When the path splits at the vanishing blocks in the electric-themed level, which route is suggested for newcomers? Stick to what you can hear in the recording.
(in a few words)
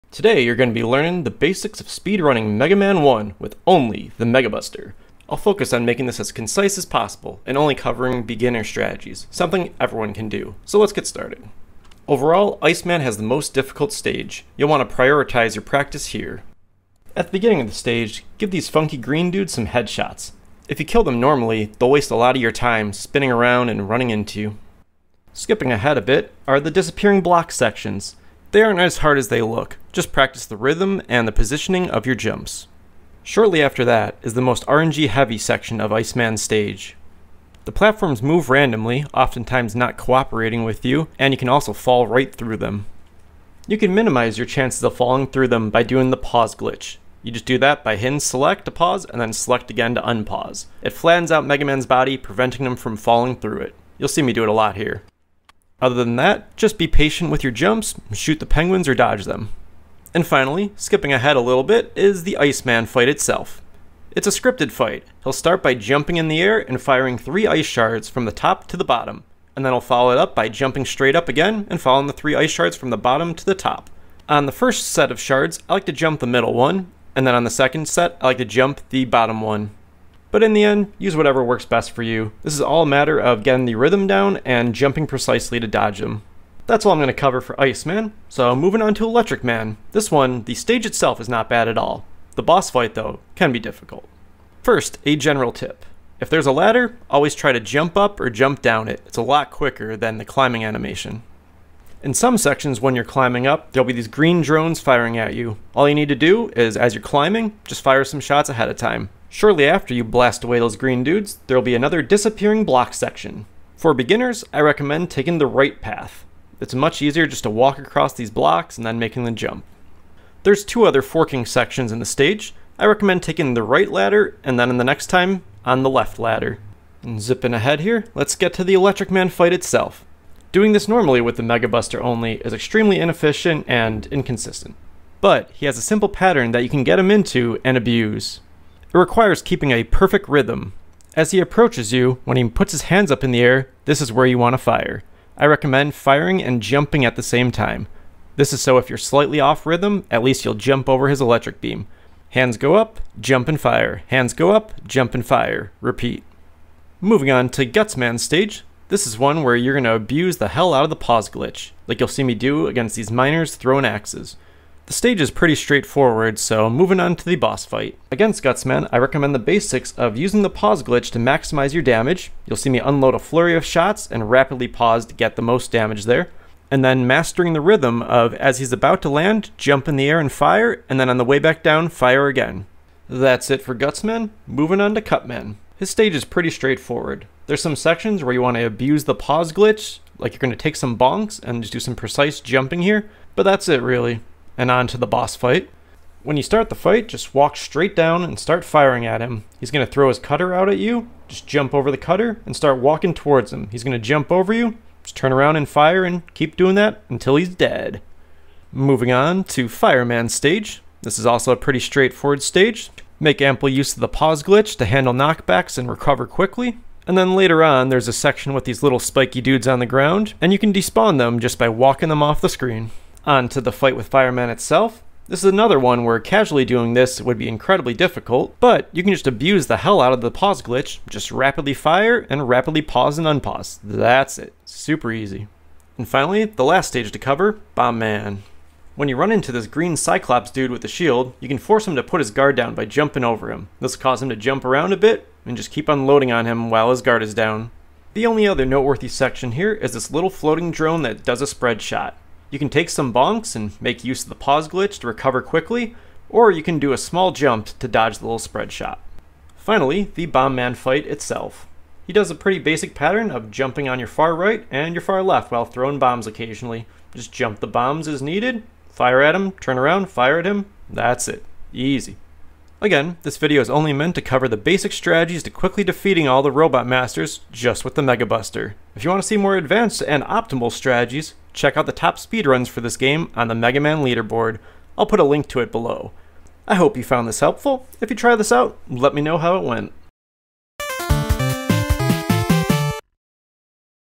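The right path.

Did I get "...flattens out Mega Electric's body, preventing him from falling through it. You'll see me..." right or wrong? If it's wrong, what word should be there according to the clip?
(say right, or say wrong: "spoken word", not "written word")
wrong: "Man", not "Electric".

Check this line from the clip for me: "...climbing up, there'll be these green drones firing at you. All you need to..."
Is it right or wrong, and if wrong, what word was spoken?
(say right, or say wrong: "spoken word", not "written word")
right.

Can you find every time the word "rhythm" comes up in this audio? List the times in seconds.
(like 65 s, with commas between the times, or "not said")
30 s, 83 s, 140 s, 149 s, 177 s.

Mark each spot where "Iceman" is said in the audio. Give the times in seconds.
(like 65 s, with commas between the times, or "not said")
12 s, 35 s, 62 s, 87 s.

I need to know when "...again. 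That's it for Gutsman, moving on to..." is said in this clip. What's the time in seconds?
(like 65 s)
182 s.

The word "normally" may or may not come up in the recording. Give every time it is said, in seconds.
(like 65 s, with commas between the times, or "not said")
21 s, 130 s.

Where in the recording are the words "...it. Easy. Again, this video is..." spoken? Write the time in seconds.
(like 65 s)
271 s.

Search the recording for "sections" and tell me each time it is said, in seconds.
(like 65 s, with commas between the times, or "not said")
27 s, 35 s, 102 s, 112 s, 121 s, 187 s, 218 s, 249 s.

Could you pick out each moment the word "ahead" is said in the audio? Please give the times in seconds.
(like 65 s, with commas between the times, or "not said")
25 s, 61 s, 108 s, 127 s.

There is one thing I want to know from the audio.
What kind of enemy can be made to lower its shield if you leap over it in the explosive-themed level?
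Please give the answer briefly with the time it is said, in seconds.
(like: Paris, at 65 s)
Green Cyclops, at 239 s.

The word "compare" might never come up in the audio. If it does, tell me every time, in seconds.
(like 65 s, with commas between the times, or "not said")
not said.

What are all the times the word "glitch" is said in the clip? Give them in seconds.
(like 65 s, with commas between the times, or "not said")
46 s, 161 s, 170 s, 189 s, 214 s, 230 s, 254 s.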